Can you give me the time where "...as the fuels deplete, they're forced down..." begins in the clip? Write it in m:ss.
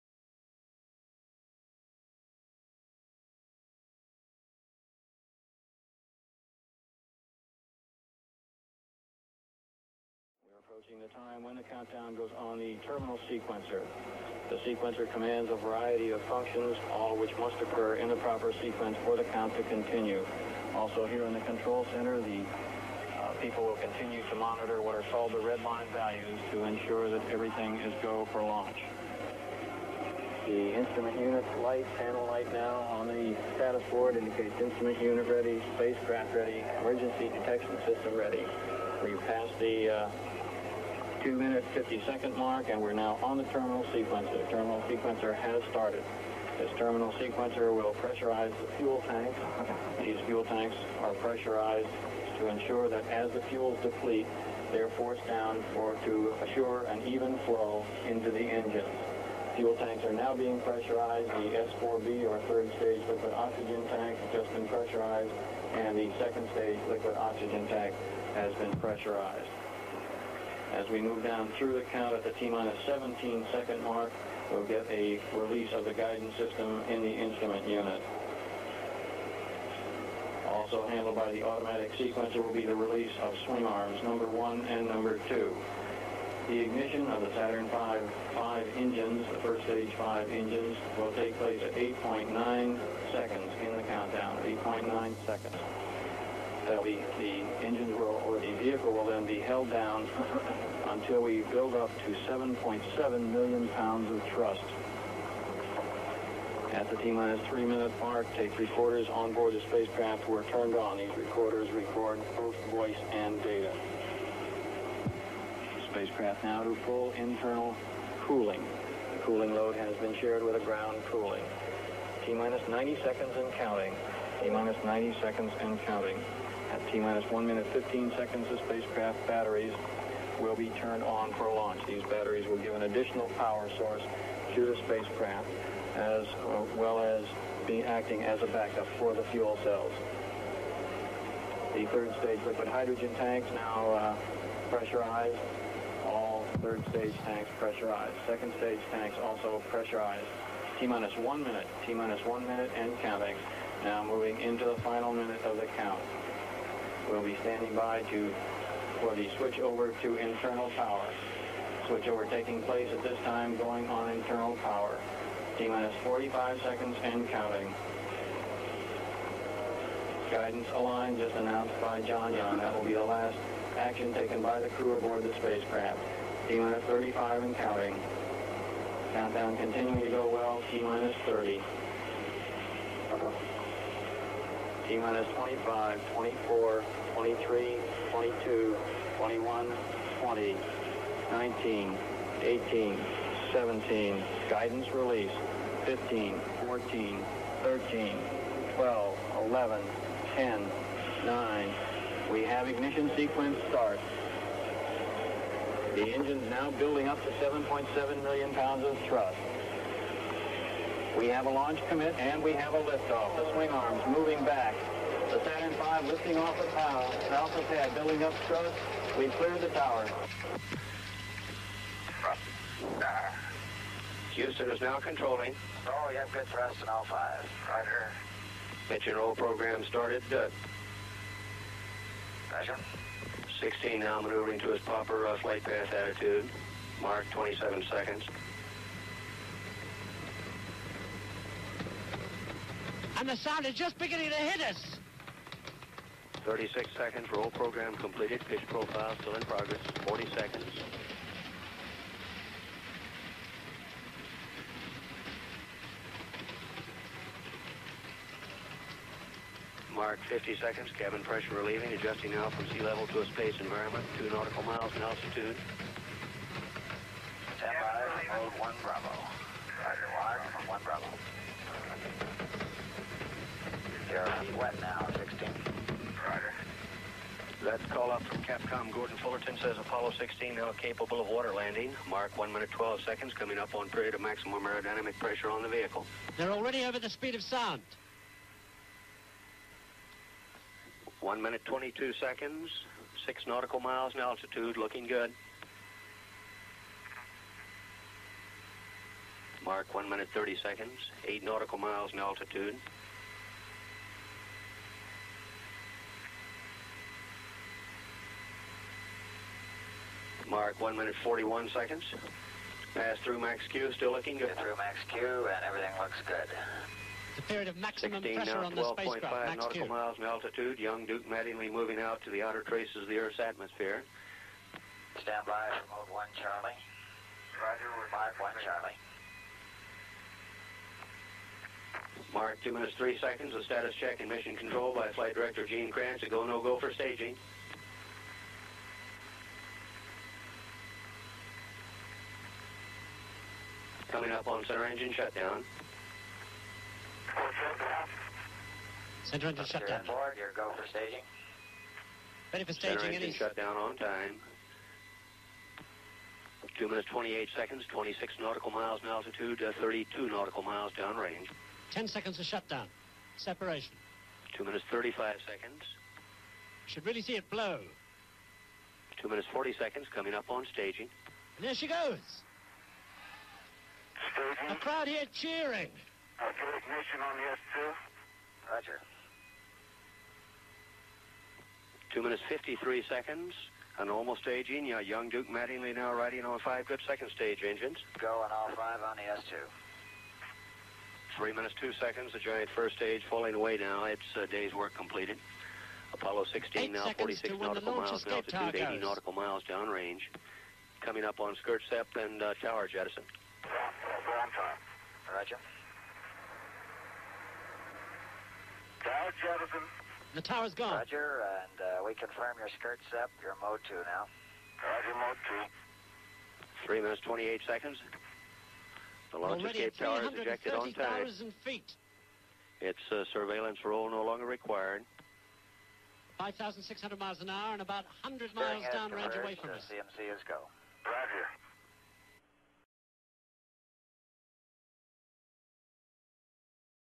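0:53.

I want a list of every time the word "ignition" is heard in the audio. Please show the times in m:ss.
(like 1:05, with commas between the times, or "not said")
1:26, 6:16.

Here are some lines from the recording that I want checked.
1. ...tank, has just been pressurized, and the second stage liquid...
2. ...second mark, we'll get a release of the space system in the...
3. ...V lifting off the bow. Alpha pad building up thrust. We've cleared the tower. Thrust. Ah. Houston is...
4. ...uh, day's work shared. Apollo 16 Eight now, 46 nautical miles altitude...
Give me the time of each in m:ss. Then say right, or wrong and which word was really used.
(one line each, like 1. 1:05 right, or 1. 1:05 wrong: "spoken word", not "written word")
1. 1:03 right
2. 1:13 wrong: "guidance", not "space"
3. 3:35 right
4. 6:34 wrong: "completed", not "shared".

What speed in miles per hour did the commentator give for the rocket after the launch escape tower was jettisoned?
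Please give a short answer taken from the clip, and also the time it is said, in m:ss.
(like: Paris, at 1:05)
5,600 miles an hour, at 7:06.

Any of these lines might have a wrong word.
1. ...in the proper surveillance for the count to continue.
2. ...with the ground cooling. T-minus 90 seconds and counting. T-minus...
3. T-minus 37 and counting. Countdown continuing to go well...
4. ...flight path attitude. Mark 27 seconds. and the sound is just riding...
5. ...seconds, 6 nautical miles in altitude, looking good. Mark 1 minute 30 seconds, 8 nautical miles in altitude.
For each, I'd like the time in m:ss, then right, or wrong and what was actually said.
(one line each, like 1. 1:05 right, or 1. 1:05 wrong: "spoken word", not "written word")
1. 0:17 wrong: "sequence", not "surveillance"
2. 2:00 right
3. 2:56 wrong: "35", not "37"
4. 3:55 wrong: "beginning", not "riding"
5. 4:52 right.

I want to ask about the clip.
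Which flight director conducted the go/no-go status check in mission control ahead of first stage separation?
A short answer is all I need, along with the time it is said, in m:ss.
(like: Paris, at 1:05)
Gene Kranz, at 5:35.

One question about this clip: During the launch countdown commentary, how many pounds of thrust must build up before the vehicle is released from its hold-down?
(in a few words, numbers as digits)
7.7 million pounds.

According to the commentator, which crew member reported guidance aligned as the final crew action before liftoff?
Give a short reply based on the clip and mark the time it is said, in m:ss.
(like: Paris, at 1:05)
John Young, at 2:52.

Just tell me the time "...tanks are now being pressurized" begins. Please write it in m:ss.
0:59.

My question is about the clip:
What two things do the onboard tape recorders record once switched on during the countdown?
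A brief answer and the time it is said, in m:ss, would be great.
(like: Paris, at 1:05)
Voice and data, at 1:52.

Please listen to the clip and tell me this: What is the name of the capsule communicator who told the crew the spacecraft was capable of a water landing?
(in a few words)
Gordon Fullerton.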